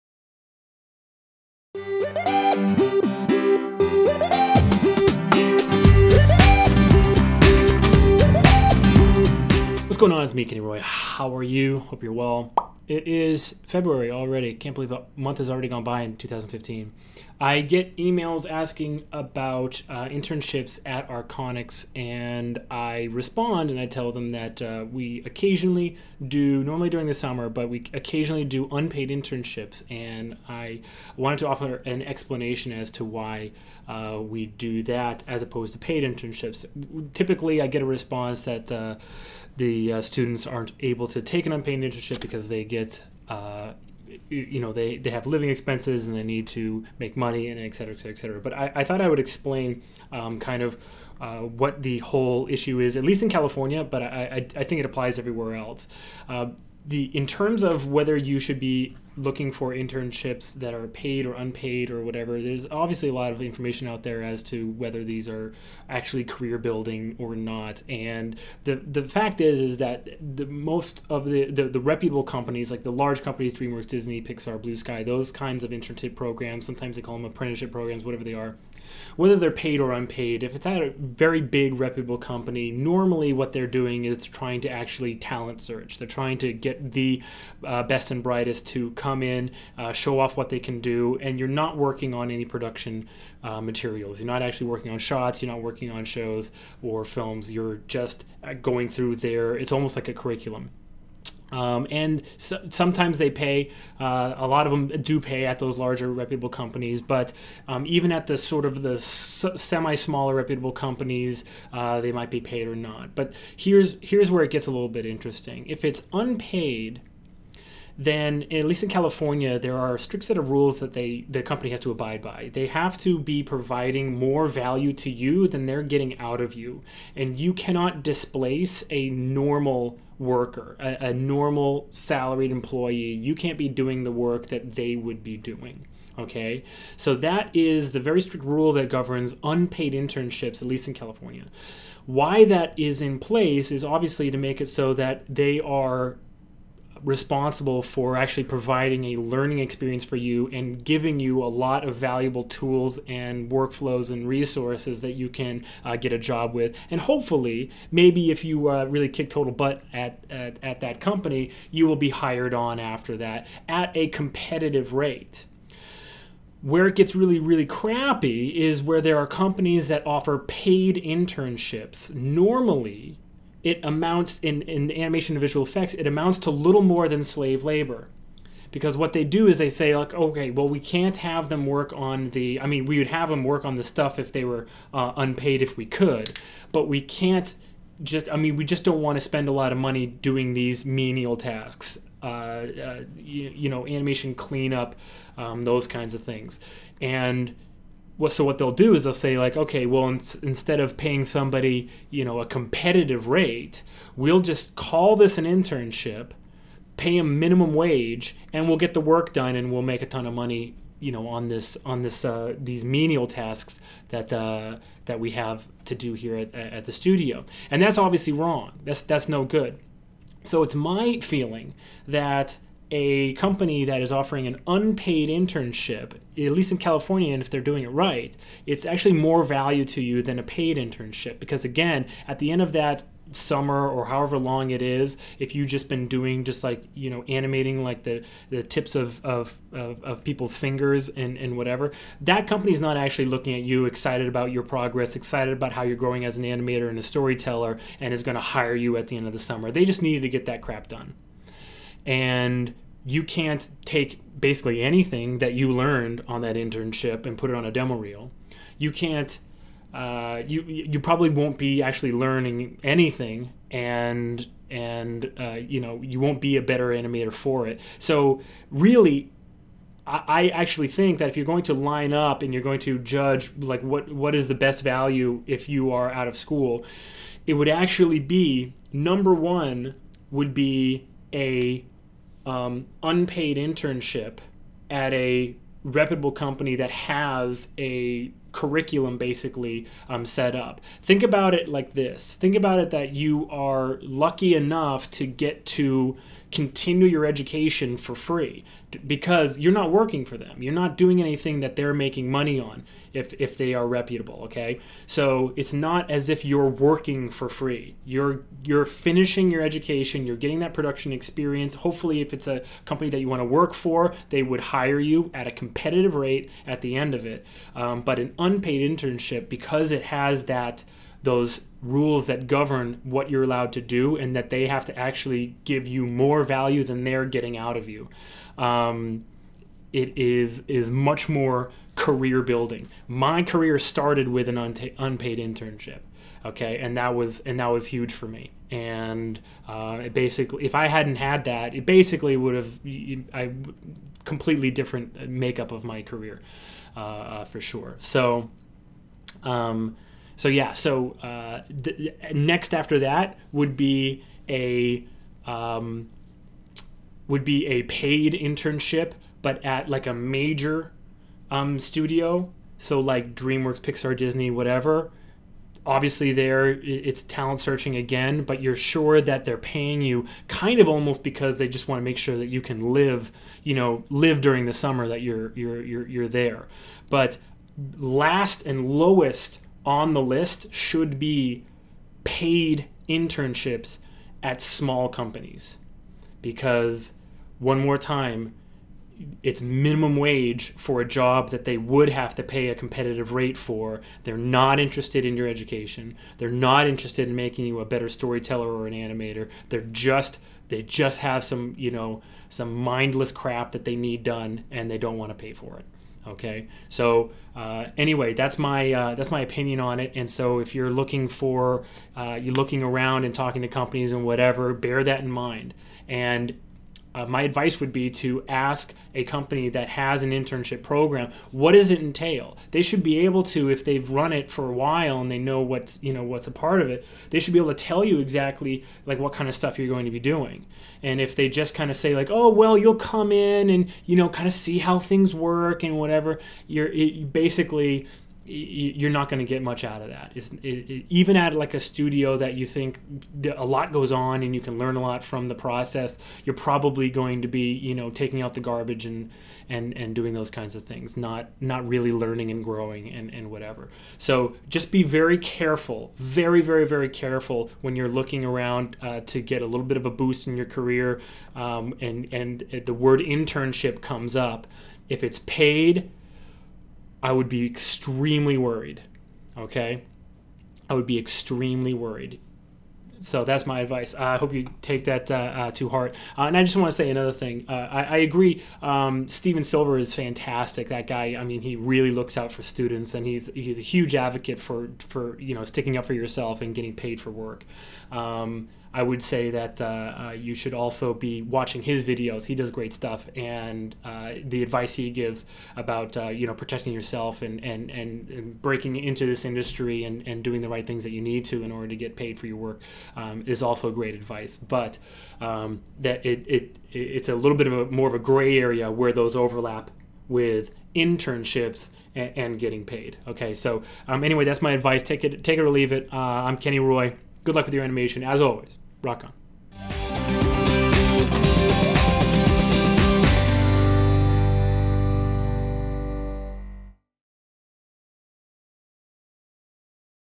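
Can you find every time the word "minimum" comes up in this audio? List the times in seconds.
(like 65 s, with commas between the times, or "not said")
207 s, 389 s.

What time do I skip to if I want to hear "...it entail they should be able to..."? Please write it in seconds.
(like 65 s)
421 s.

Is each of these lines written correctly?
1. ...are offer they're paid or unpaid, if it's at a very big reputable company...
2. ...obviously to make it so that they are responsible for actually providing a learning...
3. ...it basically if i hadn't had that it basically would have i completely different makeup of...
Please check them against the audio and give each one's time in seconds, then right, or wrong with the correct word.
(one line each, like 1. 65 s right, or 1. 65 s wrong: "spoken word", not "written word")
1. 78 s wrong: "whether", not "offer"
2. 143 s right
3. 340 s right.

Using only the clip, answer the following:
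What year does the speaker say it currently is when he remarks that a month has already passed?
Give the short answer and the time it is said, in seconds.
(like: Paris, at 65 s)
2015, at 16 s.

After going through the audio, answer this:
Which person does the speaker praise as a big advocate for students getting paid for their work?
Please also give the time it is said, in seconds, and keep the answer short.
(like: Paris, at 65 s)
Stephen Silver, at 479 s.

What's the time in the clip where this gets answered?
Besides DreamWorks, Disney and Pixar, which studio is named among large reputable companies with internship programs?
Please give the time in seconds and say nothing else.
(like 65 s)
74 s.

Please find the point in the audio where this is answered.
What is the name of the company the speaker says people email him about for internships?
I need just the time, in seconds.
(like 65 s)
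21 s.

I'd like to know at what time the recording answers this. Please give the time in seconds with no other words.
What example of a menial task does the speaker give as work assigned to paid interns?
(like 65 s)
193 s.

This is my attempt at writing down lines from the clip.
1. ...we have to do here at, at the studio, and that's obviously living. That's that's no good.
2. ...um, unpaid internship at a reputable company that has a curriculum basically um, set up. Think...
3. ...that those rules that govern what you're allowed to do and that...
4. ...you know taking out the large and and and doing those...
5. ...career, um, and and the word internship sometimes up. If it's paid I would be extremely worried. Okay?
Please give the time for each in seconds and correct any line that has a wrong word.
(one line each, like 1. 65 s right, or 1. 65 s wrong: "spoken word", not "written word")
1. 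215 s wrong: "wrong", not "living"
2. 282 s right
3. 320 s right
4. 447 s wrong: "garbage", not "large"
5. 460 s wrong: "comes", not "sometimes".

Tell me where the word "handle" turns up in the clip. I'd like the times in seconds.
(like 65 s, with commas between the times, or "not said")
not said.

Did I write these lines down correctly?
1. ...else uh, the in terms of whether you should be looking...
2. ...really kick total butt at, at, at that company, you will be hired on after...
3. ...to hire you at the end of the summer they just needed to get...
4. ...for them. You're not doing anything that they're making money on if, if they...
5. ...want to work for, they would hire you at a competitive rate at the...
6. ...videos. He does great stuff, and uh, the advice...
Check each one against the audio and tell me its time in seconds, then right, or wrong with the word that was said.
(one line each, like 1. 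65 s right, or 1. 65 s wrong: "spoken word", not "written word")
1. 55 s right
2. 158 s right
3. 248 s right
4. 300 s right
5. 313 s right
6. 492 s right.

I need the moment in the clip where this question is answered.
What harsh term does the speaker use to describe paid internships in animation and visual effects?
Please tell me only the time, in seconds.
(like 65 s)
177 s.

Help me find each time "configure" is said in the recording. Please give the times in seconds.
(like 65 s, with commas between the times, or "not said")
not said.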